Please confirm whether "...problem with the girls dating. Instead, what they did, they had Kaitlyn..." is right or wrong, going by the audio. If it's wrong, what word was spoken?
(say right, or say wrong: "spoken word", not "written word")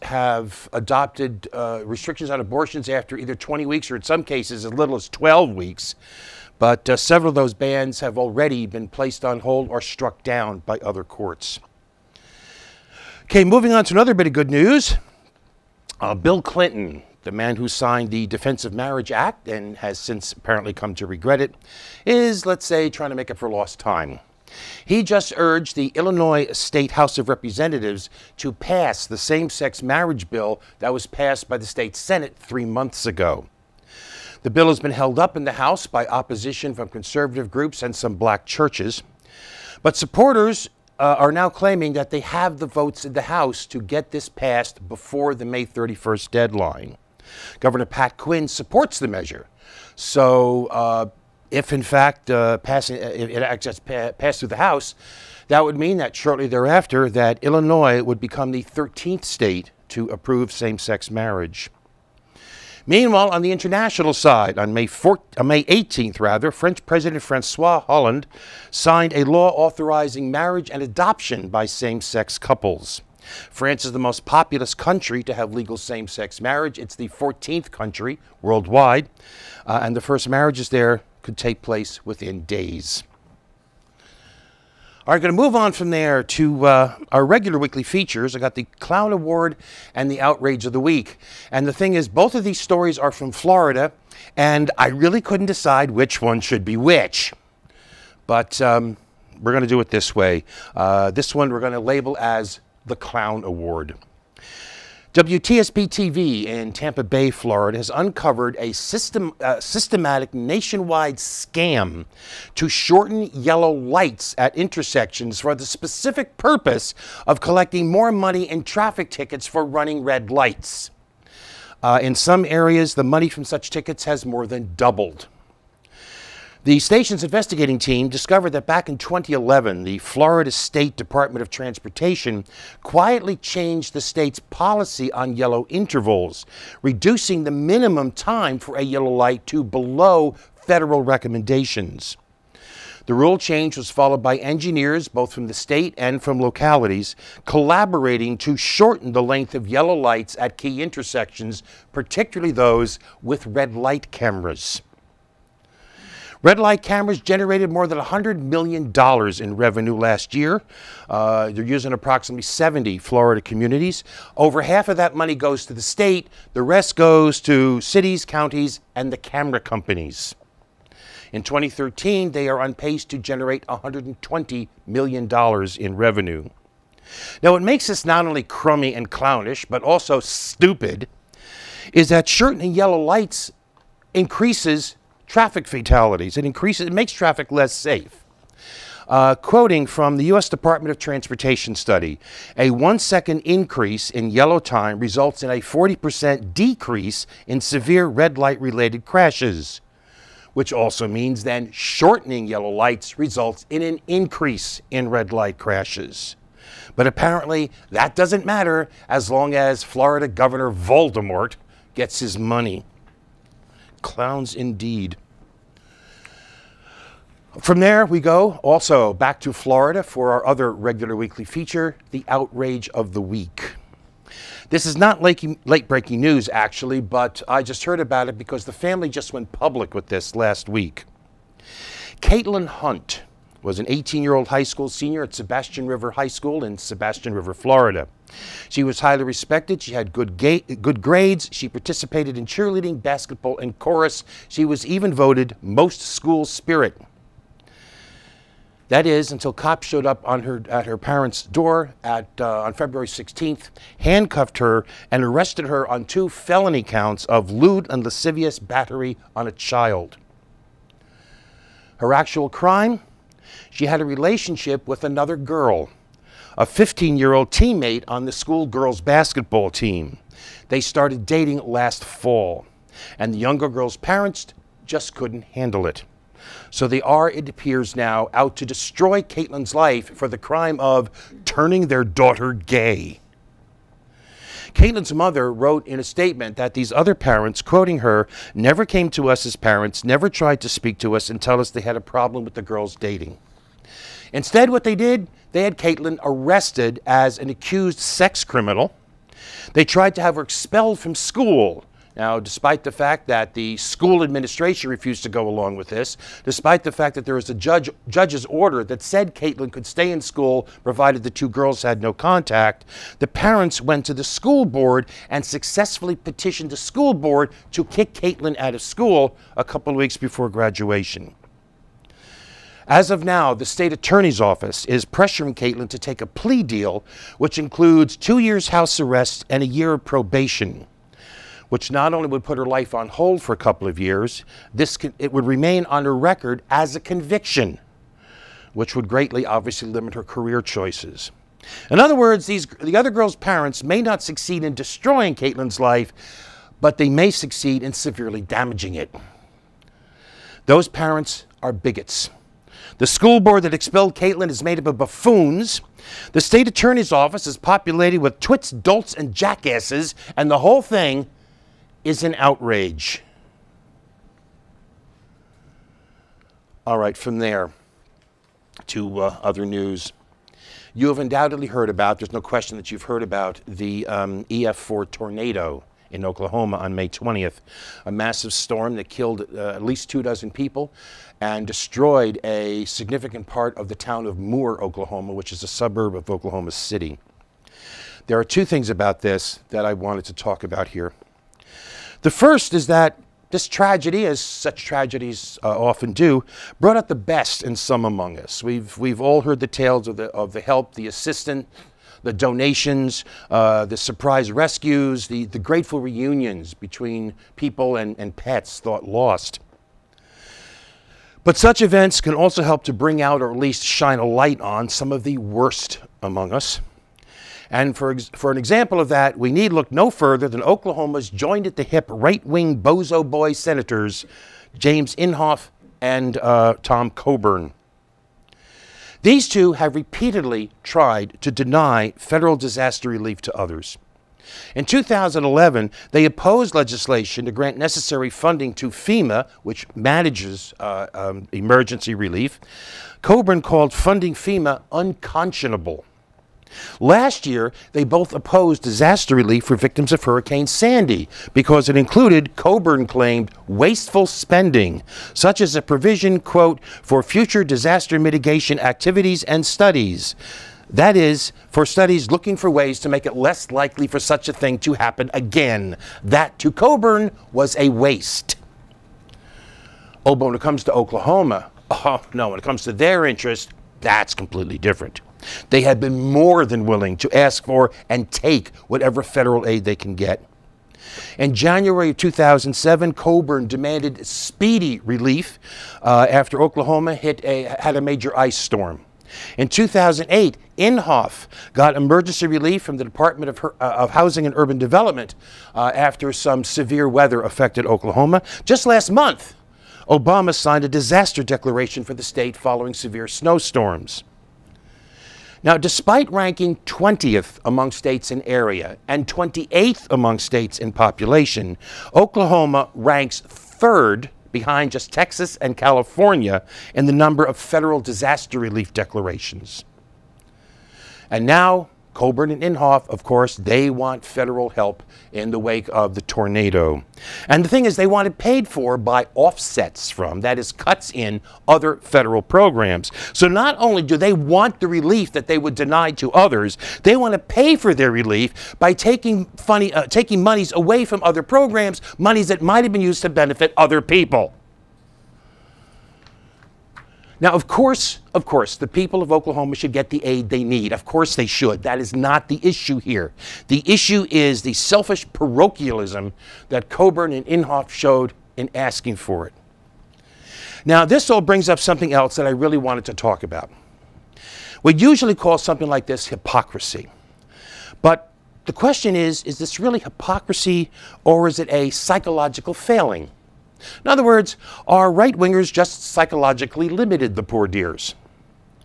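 right.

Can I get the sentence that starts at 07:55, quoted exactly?
They have been more than willing to ask for and take whatever federal aid they can get.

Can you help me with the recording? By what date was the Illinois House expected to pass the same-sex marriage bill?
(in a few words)
May 31st.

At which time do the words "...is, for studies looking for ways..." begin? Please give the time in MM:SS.
07:41.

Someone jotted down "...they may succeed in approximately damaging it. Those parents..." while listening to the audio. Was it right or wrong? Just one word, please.
wrong.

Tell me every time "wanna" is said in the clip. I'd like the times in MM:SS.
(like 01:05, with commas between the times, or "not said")
not said.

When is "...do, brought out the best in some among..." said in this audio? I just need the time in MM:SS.
06:36.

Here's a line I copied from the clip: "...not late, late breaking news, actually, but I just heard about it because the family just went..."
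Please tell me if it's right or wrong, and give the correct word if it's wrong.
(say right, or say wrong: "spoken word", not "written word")
right.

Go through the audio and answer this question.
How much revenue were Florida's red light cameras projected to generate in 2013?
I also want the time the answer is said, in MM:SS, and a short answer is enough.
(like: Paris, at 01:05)
$120 million, at 02:53.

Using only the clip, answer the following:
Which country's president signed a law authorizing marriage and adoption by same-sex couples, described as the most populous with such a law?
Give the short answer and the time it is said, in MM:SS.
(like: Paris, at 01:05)
France, at 01:13.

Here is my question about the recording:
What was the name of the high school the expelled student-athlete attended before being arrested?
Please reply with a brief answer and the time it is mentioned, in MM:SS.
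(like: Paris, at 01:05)
Sebastian River High School, at 03:55.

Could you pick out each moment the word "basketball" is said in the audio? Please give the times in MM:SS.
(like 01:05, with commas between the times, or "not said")
04:03, 04:28.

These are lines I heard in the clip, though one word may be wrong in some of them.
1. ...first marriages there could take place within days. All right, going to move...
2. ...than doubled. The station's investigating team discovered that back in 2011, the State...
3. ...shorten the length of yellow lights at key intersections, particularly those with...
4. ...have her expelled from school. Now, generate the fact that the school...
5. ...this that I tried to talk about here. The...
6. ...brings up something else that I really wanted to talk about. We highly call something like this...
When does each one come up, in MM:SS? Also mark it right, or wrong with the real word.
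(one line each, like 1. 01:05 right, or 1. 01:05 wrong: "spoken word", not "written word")
1. 01:19 right
2. 02:04 wrong: "Florida", not "State"
3. 02:28 right
4. 05:00 wrong: "despite", not "generate"
5. 06:29 wrong: "wanted", not "tried"
6. 09:21 wrong: "usually", not "highly".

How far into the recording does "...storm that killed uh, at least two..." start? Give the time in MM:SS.
06:18.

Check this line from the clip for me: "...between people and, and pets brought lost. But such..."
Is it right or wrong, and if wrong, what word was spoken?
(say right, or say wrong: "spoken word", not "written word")
wrong: "thought", not "brought".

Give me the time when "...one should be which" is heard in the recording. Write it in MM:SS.
01:36.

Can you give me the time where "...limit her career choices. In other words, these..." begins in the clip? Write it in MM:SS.
05:39.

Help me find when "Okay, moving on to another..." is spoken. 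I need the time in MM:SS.
00:13.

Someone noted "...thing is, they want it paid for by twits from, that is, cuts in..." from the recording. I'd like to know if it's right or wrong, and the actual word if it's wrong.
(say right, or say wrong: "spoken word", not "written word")
wrong: "offsets", not "twits".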